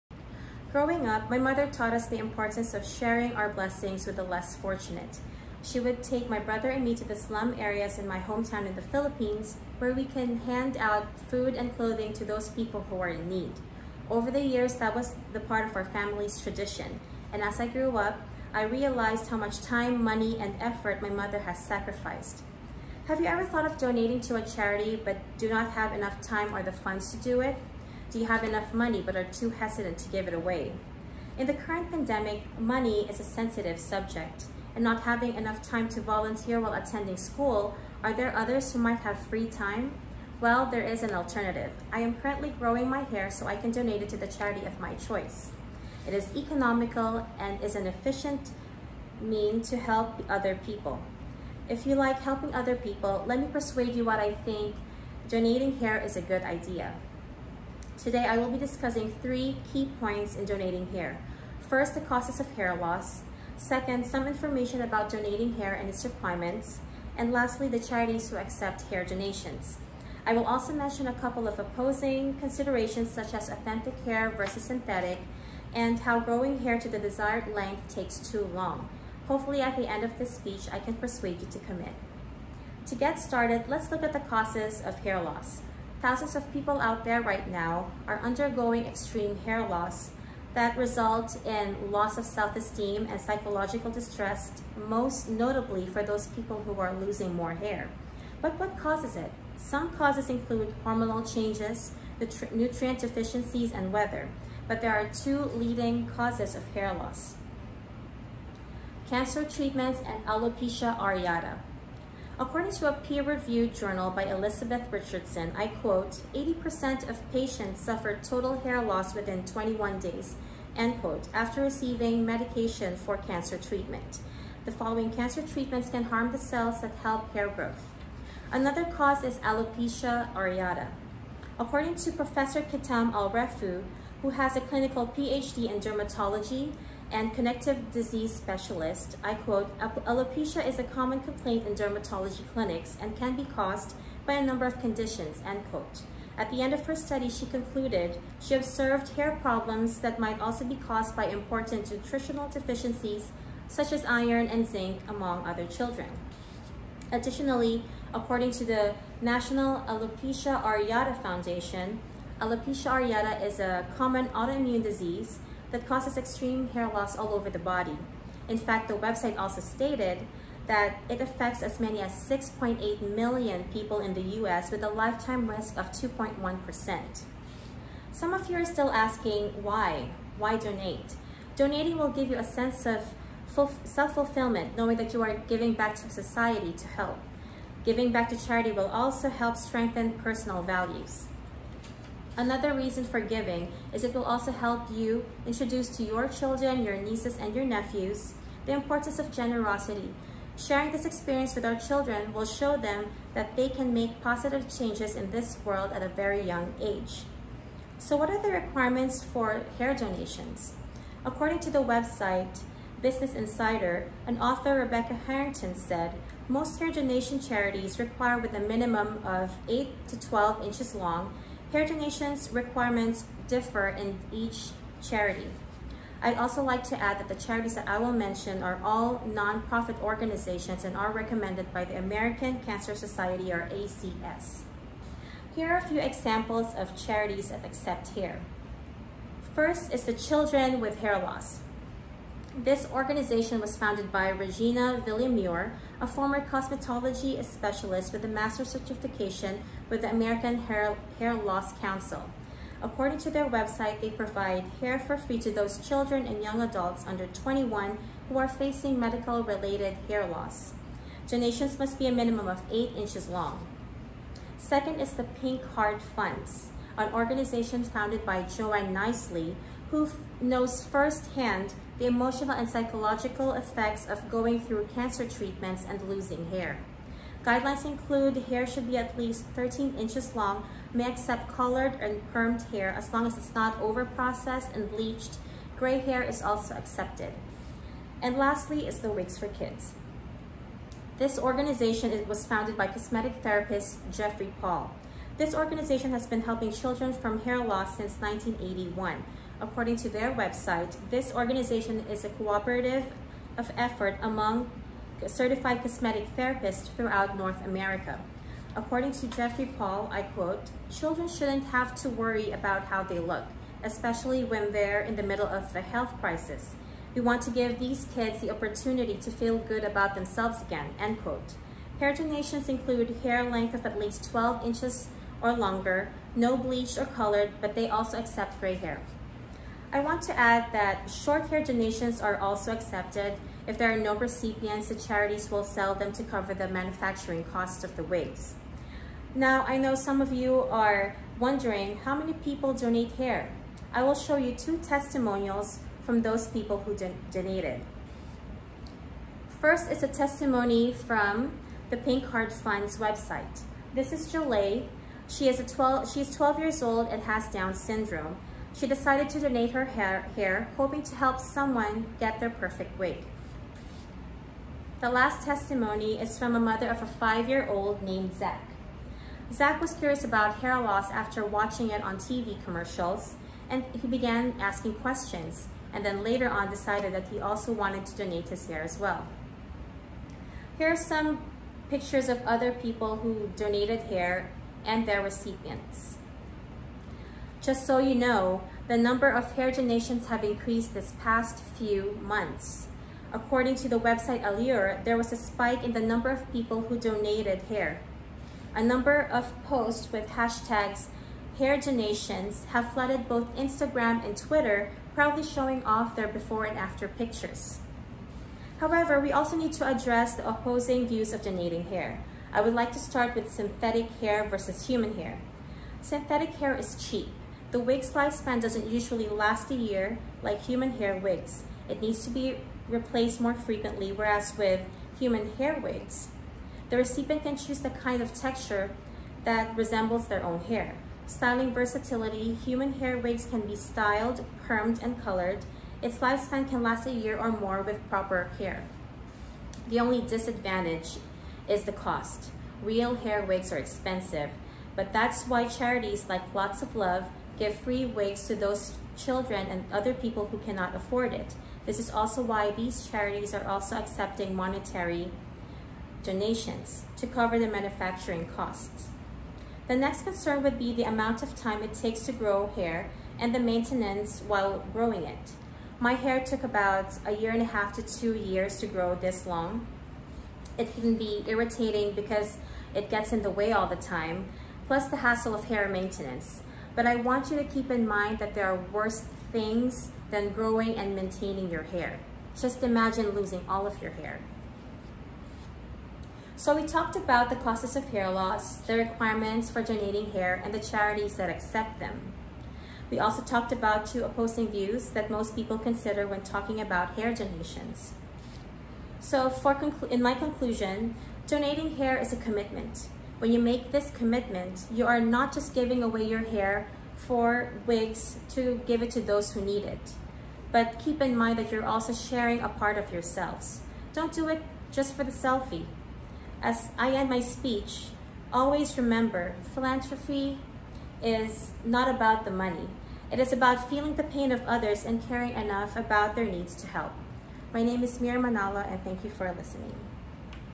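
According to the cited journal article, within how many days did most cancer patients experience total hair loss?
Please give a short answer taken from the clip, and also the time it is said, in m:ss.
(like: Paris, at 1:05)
21, at 1:59.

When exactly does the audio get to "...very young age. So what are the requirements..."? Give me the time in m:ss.
3:26.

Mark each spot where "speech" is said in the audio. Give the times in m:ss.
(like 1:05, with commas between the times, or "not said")
1:20, 8:37.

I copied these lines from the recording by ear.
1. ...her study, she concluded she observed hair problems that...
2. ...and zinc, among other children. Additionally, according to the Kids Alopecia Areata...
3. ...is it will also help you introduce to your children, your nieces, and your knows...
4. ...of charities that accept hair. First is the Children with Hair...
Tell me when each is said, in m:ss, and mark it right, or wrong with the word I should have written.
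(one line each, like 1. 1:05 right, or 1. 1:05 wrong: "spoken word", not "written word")
1. 2:26 right
2. 2:34 wrong: "National", not "Kids"
3. 3:13 wrong: "nephews", not "knows"
4. 3:56 right.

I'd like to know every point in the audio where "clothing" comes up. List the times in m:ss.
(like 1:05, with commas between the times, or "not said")
0:11.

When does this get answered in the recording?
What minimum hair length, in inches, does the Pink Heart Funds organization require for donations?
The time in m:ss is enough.
4:39.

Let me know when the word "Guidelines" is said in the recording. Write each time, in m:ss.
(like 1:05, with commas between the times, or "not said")
4:37.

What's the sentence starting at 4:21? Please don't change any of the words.
Donations must be a minimum of 8 inches long.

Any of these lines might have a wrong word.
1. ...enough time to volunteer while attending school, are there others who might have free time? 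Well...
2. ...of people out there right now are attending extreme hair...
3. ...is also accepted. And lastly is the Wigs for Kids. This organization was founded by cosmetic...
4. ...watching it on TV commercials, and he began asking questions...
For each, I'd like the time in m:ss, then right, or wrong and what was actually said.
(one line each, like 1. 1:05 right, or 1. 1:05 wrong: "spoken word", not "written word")
1. 0:35 right
2. 1:26 wrong: "undergoing", not "attending"
3. 4:46 right
4. 6:11 right.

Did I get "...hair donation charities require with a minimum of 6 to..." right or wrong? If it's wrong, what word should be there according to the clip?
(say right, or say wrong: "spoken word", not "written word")
wrong: "8", not "6".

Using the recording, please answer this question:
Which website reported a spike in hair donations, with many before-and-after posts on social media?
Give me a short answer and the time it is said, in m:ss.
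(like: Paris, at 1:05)
Allure, at 6:34.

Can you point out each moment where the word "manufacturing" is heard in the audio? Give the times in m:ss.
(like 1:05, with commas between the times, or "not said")
5:36, 7:37.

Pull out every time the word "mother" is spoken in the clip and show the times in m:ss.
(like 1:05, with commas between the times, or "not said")
0:01, 0:21, 6:06.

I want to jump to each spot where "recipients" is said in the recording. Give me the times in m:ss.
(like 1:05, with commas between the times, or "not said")
5:34, 6:25, 7:06.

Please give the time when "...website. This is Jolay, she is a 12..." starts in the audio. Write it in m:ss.
5:52.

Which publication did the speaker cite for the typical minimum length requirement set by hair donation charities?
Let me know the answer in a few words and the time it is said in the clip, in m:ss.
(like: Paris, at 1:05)
Business Insider, at 3:33.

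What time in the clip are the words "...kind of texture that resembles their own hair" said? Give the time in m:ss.
7:07.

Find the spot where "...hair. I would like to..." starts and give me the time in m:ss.
6:51.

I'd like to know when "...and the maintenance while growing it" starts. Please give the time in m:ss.
7:43.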